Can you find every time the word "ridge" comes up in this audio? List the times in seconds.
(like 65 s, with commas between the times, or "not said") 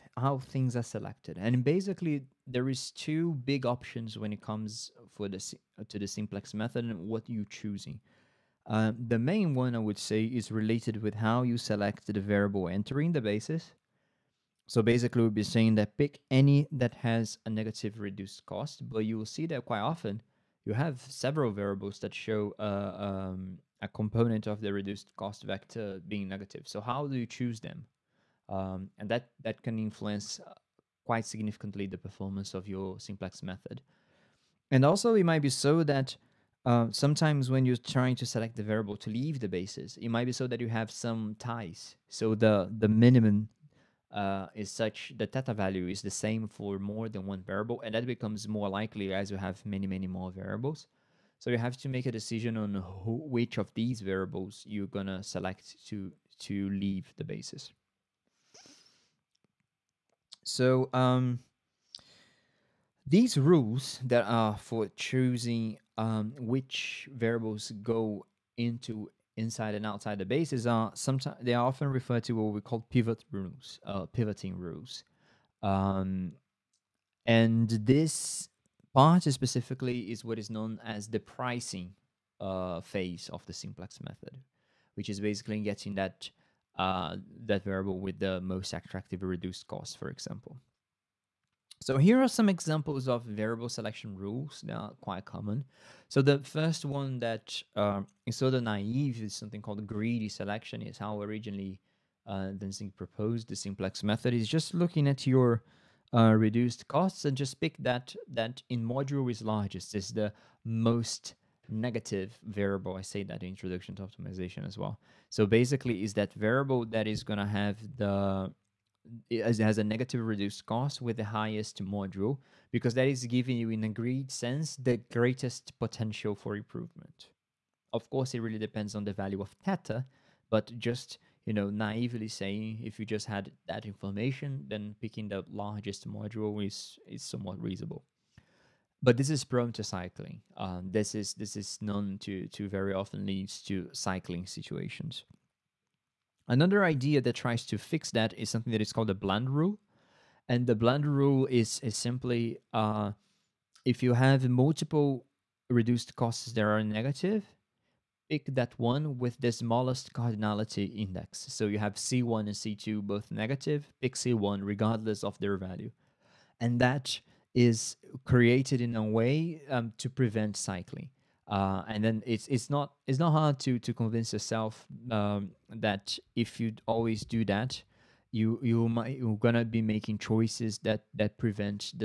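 not said.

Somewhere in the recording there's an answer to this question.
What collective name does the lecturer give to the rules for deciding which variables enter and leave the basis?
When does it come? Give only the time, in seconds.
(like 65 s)
72 s.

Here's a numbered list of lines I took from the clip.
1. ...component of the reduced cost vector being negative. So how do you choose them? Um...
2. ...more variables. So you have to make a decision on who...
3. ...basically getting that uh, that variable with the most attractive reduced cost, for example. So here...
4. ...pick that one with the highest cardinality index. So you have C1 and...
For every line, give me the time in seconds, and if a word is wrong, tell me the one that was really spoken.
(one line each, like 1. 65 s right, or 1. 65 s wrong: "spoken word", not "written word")
1. 23 s right
2. 50 s right
3. 85 s right
4. 158 s wrong: "smallest", not "highest".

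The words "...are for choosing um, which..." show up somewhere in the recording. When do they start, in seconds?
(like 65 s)
64 s.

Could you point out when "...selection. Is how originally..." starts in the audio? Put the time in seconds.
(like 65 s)
100 s.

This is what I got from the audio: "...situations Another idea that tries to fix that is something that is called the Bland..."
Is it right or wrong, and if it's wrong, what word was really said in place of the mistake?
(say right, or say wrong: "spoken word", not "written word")
right.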